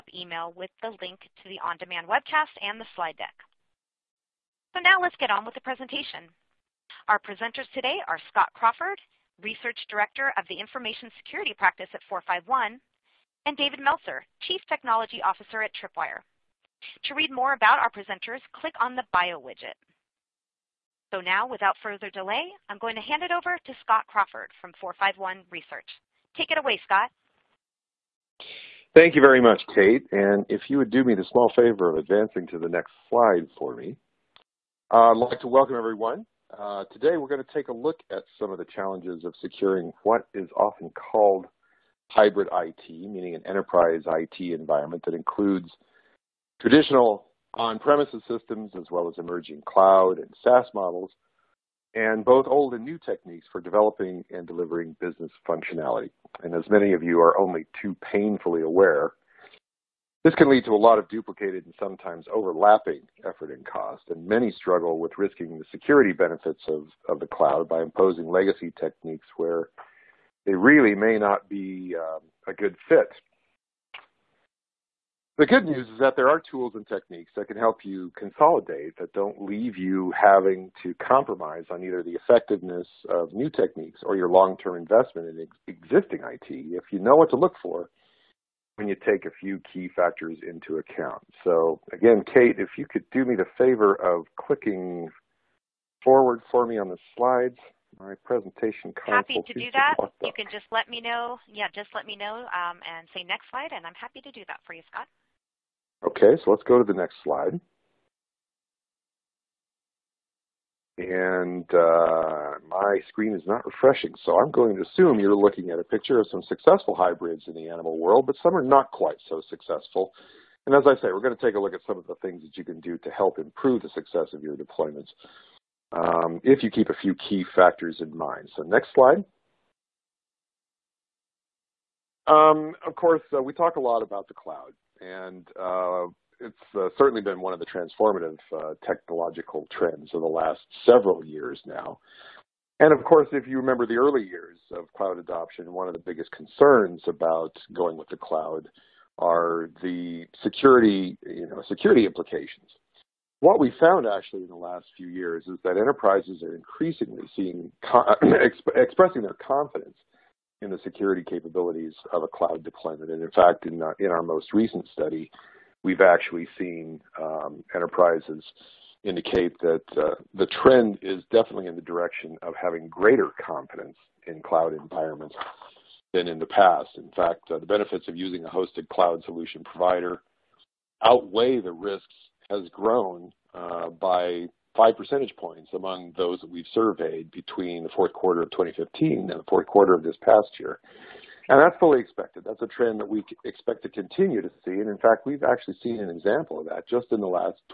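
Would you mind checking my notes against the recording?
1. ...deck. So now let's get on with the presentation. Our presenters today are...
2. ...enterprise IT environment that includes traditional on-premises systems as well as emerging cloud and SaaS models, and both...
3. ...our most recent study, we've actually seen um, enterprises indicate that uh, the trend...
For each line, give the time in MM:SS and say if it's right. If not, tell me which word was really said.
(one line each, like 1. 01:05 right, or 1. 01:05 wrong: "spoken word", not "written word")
1. 00:03 right
2. 00:43 right
3. 02:44 right.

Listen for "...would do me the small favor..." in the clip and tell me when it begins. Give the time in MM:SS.
00:30.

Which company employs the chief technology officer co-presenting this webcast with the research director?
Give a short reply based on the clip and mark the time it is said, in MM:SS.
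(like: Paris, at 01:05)
Tripwire, at 00:15.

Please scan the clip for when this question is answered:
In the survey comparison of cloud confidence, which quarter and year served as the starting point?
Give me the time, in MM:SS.
03:07.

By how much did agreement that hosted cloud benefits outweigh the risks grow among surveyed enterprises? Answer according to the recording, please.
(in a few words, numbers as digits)
5 percentage points.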